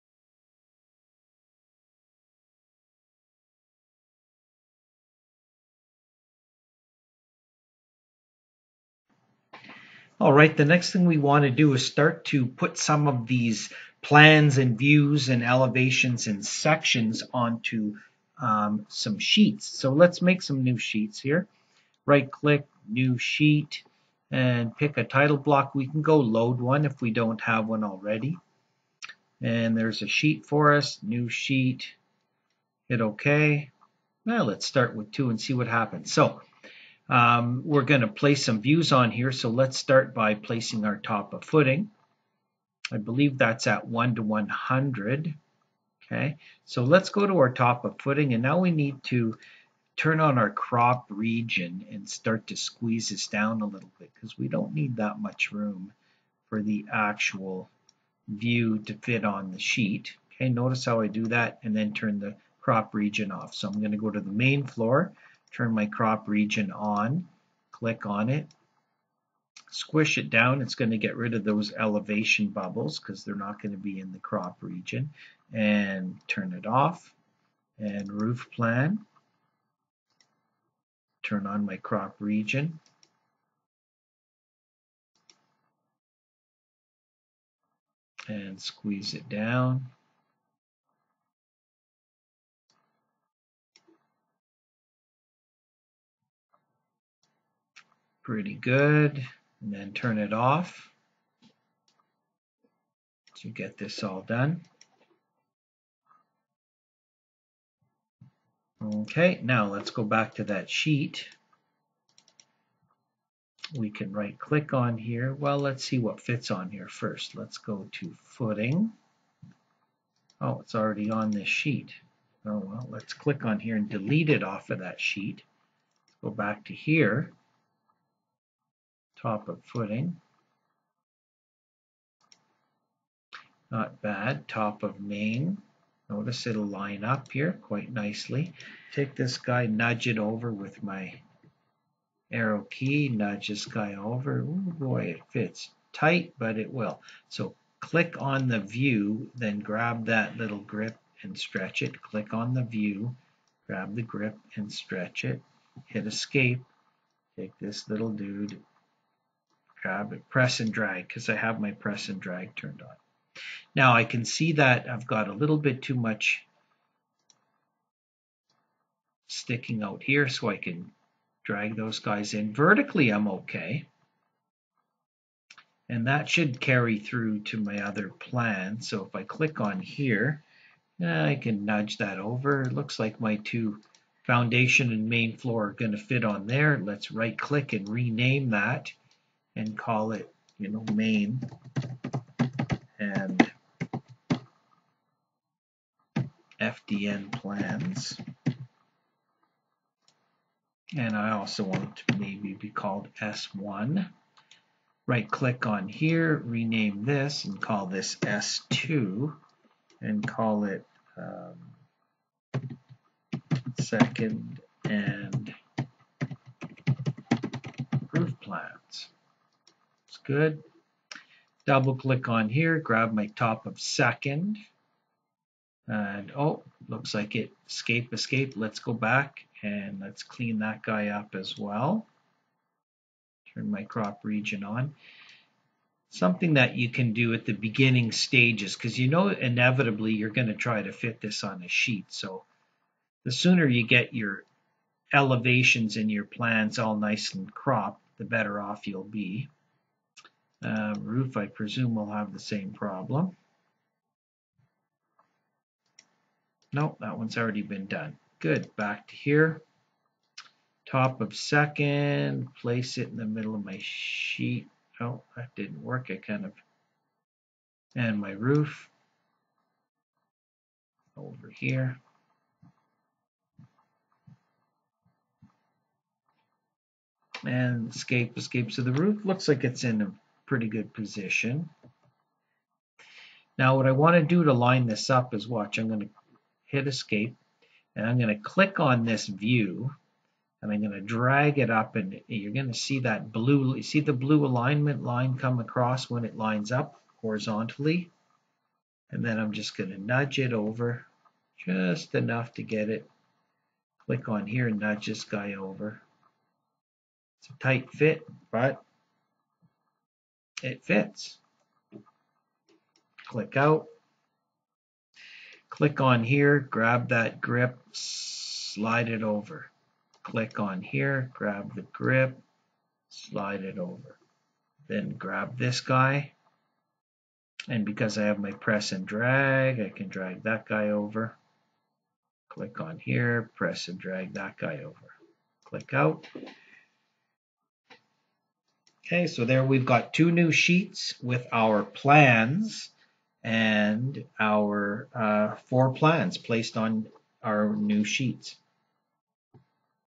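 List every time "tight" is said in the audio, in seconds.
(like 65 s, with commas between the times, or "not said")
145 s, 307 s.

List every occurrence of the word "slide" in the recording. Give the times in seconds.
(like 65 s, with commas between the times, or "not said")
317 s, 323 s.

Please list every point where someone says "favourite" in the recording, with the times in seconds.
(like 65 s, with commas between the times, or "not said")
not said.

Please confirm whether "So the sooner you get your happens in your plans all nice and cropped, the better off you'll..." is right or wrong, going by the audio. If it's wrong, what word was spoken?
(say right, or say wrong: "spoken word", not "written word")
wrong: "elevations", not "happens".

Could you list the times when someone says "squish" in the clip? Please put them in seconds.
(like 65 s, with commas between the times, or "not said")
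69 s.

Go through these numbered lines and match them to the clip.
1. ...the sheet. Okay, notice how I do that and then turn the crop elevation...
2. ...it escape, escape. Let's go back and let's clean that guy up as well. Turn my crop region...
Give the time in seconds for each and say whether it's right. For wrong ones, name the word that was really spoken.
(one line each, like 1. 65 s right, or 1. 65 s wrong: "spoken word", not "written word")
1. 59 s wrong: "region", not "elevation"
2. 227 s right.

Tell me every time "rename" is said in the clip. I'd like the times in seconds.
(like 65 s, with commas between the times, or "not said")
187 s, 206 s.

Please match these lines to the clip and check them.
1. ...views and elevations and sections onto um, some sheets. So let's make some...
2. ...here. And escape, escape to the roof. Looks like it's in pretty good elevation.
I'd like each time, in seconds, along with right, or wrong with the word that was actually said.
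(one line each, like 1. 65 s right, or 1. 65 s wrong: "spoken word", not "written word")
1. 14 s right
2. 271 s wrong: "position", not "elevation".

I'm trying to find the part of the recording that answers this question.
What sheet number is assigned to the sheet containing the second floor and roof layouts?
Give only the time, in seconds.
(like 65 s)
208 s.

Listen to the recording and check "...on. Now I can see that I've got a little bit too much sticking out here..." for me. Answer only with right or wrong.
right.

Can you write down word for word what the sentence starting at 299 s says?
And then I'm just going to nudge it over just enough to get it.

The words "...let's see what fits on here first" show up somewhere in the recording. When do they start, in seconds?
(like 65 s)
115 s.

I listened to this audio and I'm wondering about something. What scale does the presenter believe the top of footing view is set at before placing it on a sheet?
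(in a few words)
1 to 100.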